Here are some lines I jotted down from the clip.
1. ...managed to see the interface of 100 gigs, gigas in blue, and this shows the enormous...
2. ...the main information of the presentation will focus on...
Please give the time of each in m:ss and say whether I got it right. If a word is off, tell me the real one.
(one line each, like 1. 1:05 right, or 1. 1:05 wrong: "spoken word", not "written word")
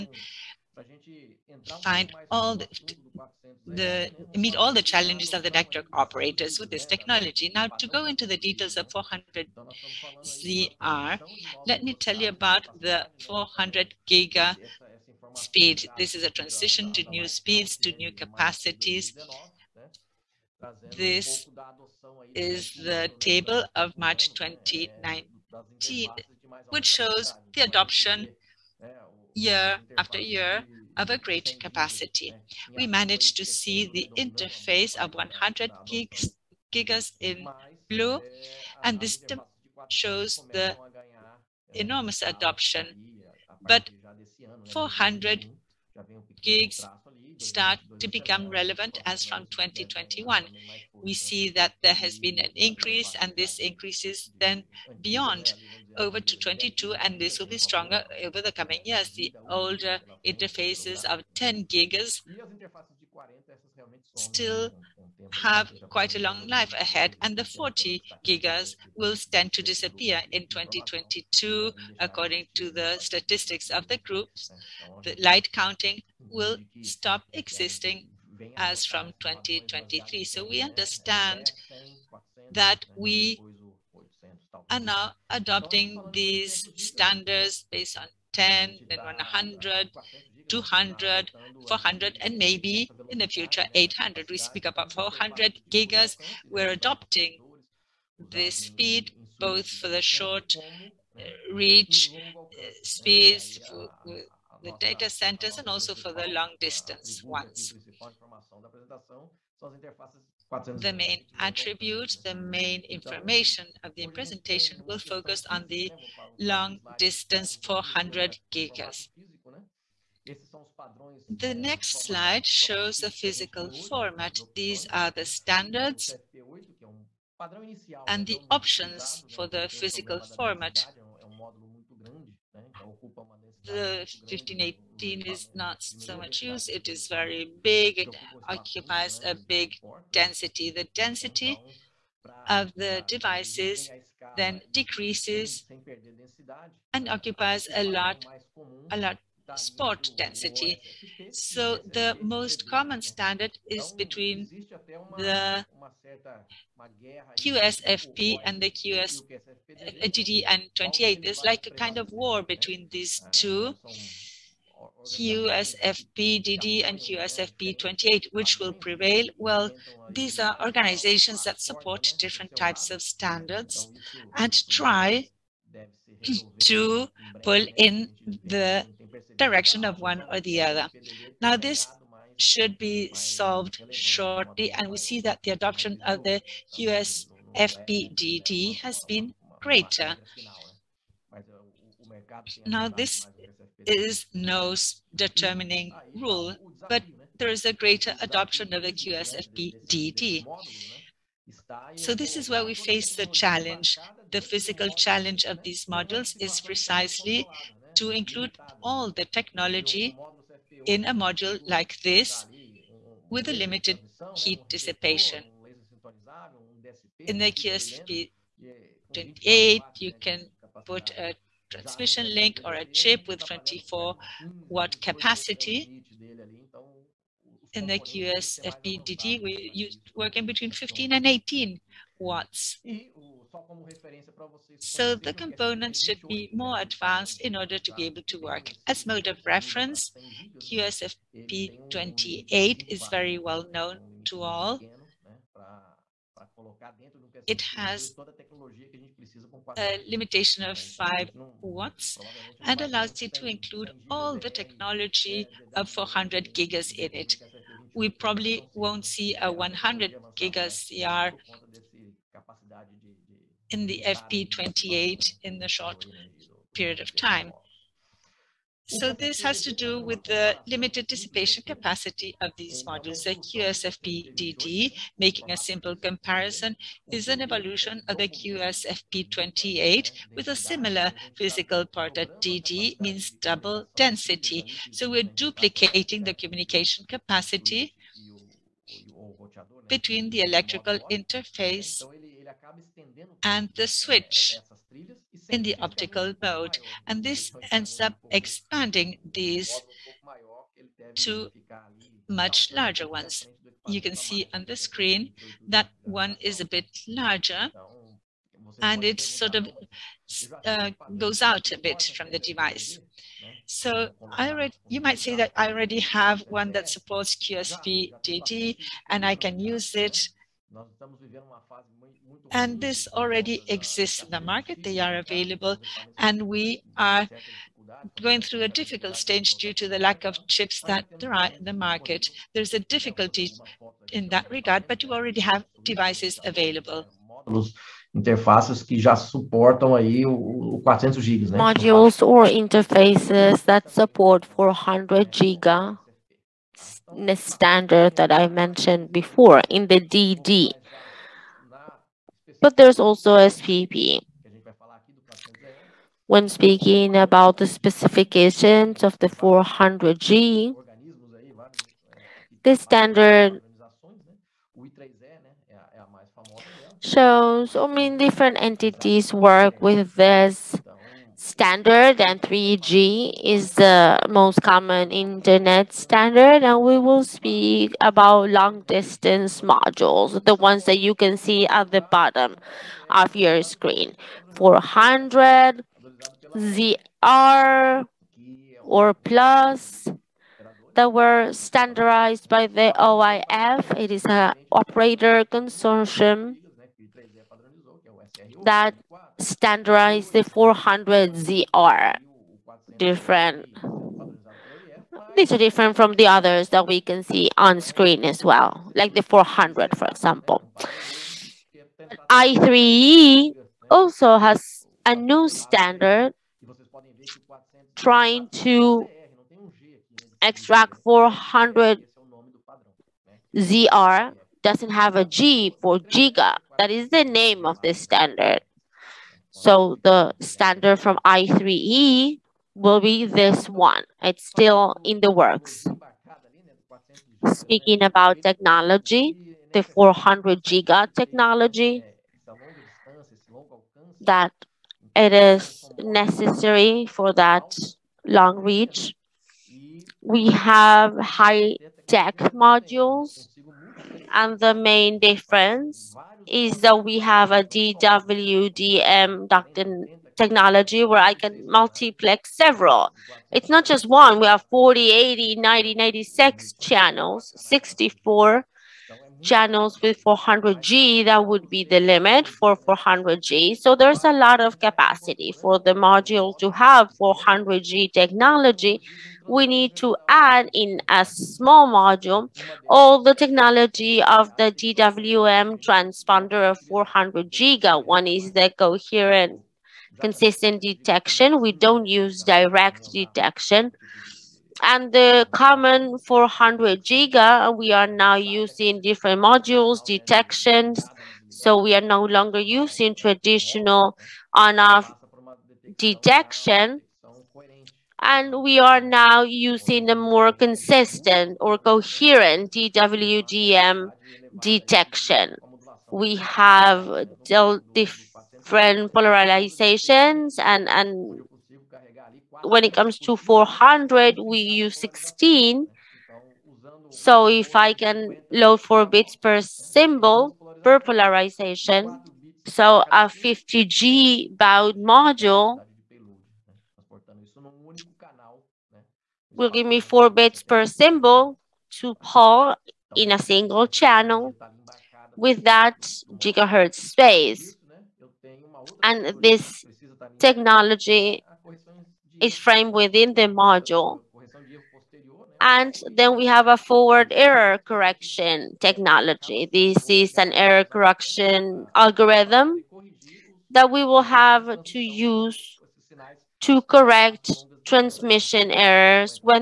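1. 0:32 right
2. 1:52 right.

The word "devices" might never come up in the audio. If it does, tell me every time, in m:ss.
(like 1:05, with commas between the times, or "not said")
2:23, 5:12, 5:35.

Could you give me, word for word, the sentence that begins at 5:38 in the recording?
interfaces que já suportam aí o, 400 gigas, né?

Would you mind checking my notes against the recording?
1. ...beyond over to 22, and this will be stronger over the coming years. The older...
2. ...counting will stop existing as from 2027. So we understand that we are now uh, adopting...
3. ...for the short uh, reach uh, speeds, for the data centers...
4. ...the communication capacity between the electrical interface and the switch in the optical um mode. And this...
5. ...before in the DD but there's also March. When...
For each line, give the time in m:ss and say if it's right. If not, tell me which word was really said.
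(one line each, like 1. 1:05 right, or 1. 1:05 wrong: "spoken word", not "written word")
1. 0:54 right
2. 1:15 wrong: "2023", not "2027"
3. 1:39 right
4. 4:46 right
5. 5:49 wrong: "SPP", not "March".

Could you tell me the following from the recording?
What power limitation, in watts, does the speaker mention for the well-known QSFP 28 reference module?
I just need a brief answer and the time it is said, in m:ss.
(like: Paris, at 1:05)
5 watts, at 4:10.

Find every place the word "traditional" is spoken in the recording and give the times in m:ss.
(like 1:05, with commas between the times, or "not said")
8:23.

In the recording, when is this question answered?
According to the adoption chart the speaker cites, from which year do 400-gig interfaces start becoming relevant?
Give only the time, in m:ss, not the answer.
0:49.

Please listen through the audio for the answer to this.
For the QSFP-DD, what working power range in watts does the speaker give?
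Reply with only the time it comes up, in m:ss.
3:50.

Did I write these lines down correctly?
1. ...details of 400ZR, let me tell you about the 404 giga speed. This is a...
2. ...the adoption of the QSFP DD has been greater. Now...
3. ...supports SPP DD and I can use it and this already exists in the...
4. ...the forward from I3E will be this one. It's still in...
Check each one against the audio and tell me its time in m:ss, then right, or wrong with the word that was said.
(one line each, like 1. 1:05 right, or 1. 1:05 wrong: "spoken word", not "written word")
1. 0:08 wrong: "400", not "404"
2. 3:05 right
3. 5:16 wrong: "QSFP", not "SPP"
4. 7:10 wrong: "standard", not "forward".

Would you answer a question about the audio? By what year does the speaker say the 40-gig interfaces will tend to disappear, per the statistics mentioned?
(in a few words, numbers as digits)
2022.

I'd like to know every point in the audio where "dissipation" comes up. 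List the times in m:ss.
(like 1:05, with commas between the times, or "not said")
3:34, 4:31.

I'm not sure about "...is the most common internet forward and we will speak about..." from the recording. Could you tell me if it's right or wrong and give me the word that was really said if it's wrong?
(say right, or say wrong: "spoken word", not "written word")
wrong: "standard", not "forward".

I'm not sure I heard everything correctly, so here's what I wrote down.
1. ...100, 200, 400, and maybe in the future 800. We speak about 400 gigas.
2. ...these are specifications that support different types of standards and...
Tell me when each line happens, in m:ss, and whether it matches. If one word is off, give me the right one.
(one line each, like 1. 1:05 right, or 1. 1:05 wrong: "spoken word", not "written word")
1. 1:28 right
2. 2:50 wrong: "organizations", not "specifications".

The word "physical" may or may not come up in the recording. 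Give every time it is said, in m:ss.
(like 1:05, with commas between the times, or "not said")
2:03, 2:09, 3:24, 4:41.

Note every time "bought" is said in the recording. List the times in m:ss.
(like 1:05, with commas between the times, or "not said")
not said.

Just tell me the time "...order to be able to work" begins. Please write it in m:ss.
3:57.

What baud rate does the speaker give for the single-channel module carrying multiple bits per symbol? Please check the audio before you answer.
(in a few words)
50G baud.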